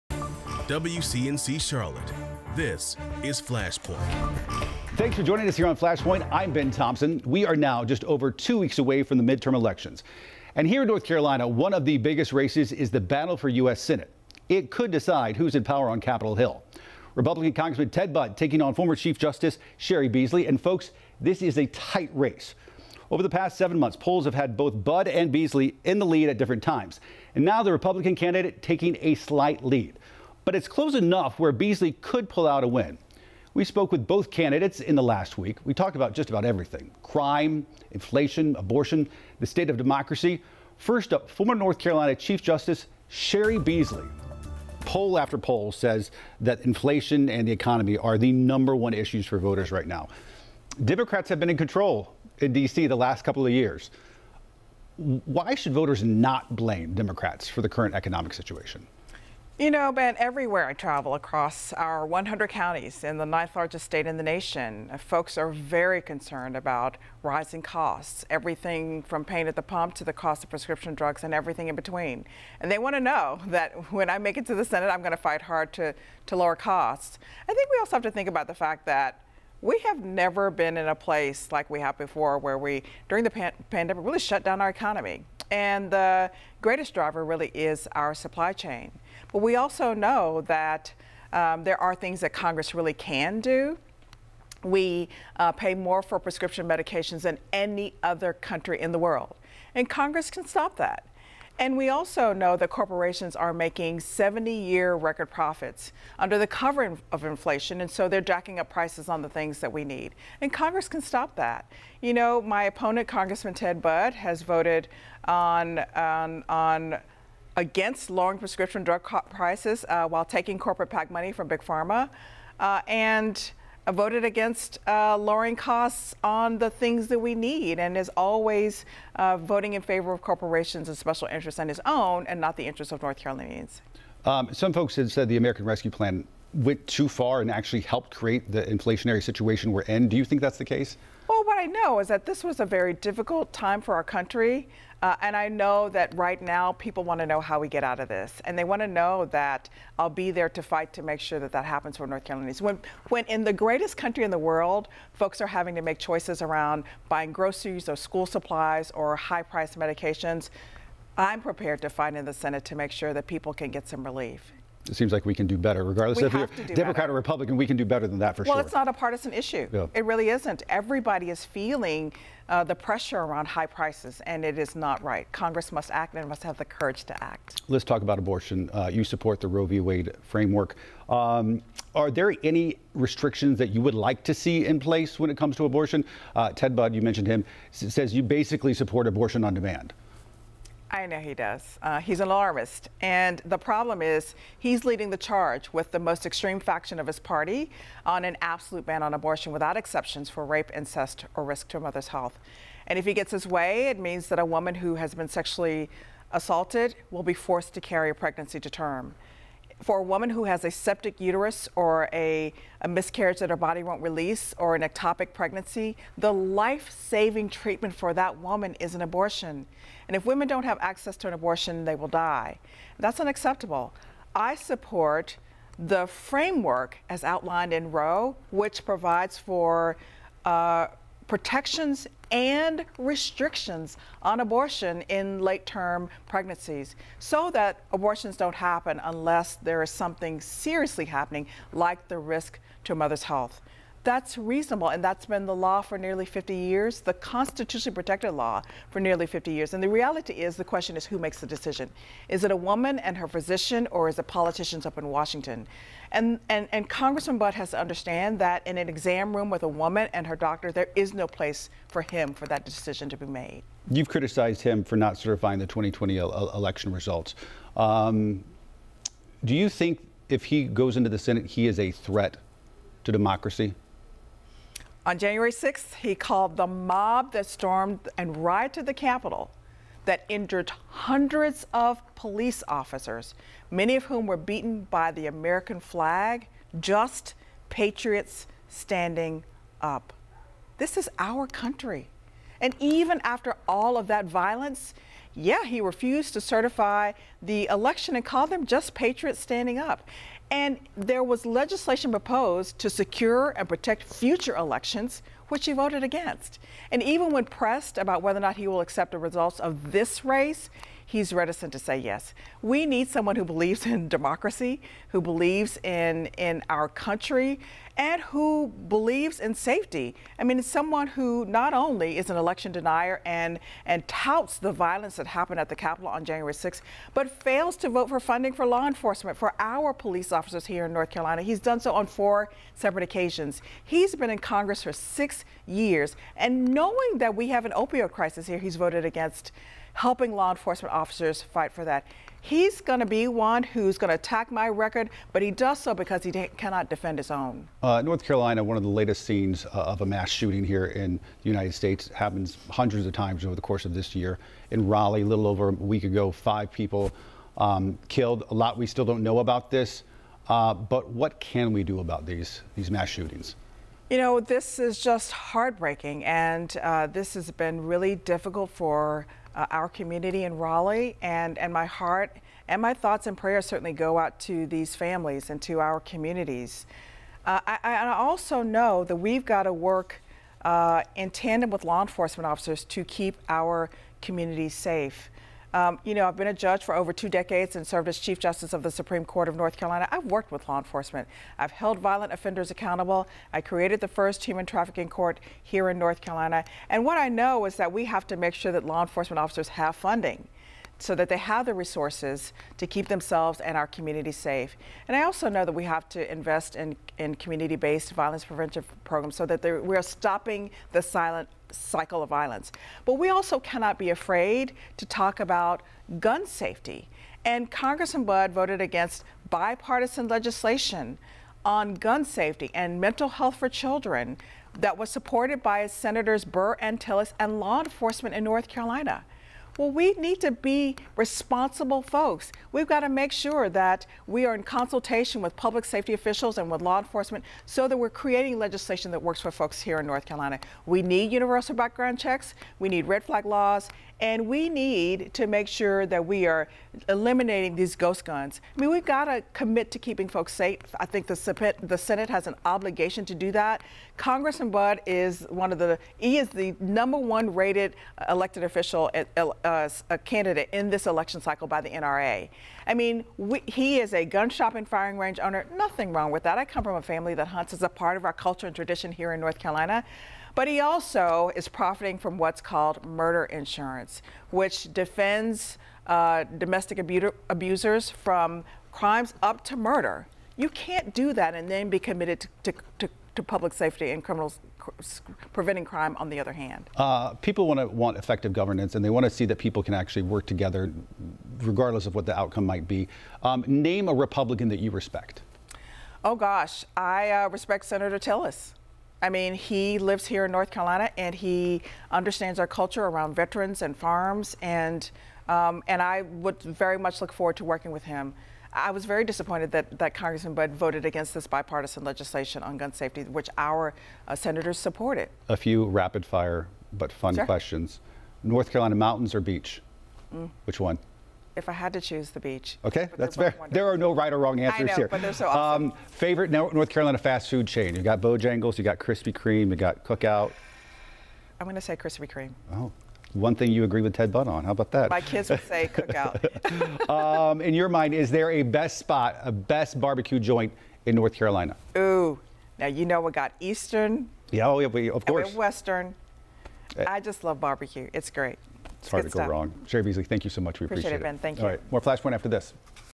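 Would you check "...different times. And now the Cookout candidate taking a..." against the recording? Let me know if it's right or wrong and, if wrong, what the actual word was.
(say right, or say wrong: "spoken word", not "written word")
wrong: "Republican", not "Cookout".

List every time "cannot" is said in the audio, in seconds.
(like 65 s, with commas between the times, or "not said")
346 s, 413 s.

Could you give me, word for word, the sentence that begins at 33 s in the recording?
We spoke with both candidates in the last week.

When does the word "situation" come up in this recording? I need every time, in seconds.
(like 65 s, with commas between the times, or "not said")
58 s, 139 s.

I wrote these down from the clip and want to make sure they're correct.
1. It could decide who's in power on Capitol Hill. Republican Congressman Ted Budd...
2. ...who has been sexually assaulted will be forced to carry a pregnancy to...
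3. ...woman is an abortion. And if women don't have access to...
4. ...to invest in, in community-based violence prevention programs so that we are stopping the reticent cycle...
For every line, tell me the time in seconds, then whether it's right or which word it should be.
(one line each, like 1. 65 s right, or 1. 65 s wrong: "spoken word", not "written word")
1. 14 s right
2. 204 s right
3. 218 s right
4. 406 s wrong: "silent", not "reticent".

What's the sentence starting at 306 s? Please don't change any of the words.
And even when pressed about whether or not he will accept the results of this race, he's reticent to say yes.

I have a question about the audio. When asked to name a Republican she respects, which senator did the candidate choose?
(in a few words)
Senator Tillis.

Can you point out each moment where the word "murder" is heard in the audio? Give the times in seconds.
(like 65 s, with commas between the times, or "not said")
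473 s, 479 s.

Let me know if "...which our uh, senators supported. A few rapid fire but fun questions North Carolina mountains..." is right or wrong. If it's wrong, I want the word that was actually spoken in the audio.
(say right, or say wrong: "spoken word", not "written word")
right.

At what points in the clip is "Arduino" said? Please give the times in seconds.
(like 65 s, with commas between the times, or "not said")
not said.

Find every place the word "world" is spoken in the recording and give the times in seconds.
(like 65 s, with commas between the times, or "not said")
98 s, 154 s.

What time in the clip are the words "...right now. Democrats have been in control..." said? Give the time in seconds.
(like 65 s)
49 s.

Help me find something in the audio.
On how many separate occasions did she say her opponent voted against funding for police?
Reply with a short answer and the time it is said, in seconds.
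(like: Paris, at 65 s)
4, at 332 s.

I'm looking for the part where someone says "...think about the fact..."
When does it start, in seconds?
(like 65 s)
78 s.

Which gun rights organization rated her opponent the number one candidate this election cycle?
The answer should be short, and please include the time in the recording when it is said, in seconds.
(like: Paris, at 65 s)
NRA, at 461 s.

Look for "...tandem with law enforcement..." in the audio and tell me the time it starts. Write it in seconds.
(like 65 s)
381 s.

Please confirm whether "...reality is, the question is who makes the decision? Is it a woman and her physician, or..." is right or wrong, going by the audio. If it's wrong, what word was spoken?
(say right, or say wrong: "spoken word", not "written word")
right.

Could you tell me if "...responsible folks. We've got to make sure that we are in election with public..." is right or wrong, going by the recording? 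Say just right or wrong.
wrong.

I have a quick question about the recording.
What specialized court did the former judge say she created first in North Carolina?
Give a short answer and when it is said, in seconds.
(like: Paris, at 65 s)
human trafficking court, at 394 s.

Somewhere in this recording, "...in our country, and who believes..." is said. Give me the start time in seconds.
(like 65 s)
316 s.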